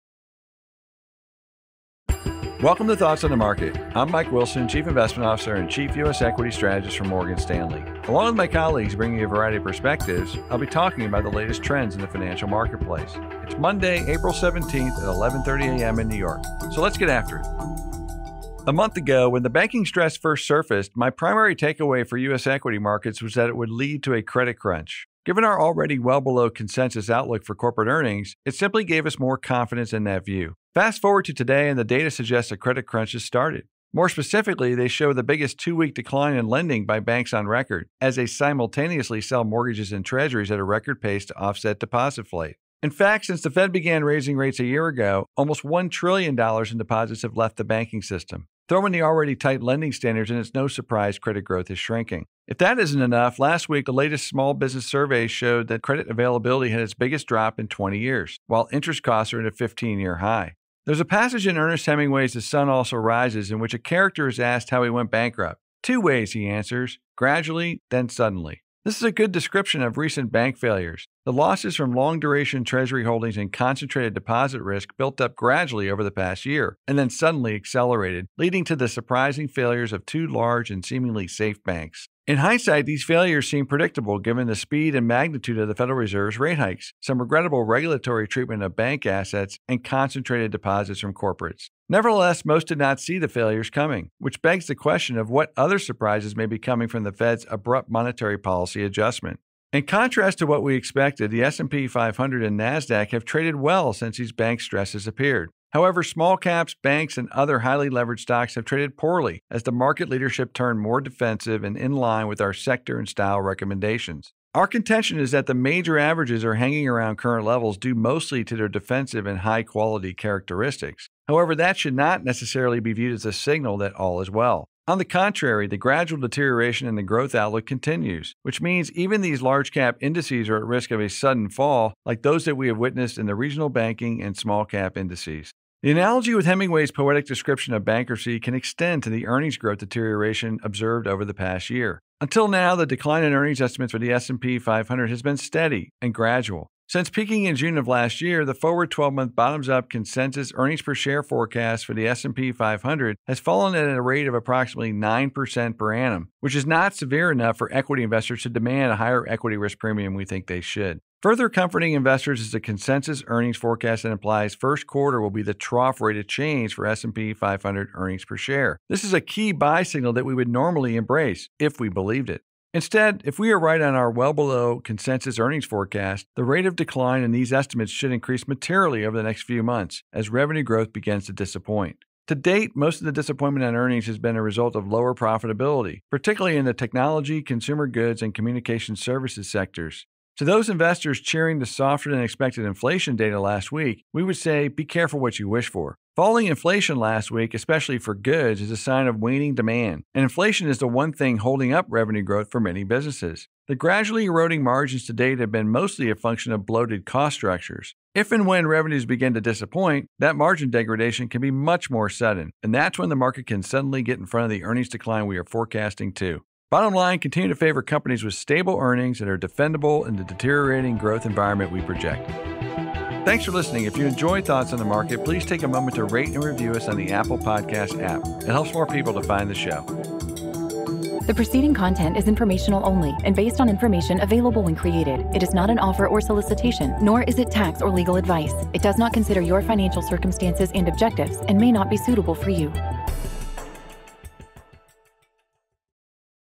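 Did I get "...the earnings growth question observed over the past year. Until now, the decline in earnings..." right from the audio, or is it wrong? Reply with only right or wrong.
wrong.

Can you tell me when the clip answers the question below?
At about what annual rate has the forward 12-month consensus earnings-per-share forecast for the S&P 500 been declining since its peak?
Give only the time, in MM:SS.
02:34.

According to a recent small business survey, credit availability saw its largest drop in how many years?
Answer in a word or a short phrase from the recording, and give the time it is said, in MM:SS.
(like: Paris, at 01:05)
20 years, at 00:57.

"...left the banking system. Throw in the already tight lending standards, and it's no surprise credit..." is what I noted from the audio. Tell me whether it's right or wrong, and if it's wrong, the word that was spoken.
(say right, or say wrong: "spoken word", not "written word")
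right.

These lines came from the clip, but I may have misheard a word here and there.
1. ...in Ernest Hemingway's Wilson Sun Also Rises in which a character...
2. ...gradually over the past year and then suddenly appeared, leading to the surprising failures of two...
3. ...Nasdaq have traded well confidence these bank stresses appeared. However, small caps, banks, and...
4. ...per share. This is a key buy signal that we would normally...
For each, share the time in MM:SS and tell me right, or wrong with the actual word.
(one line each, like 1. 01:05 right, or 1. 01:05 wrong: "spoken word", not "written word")
1. 01:01 wrong: "The", not "Wilson"
2. 01:15 wrong: "accelerated", not "appeared"
3. 01:42 wrong: "since", not "confidence"
4. 02:48 right.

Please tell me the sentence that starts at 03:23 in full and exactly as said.
The gradually eroding margins to date have been mostly a function of bloated cost structures.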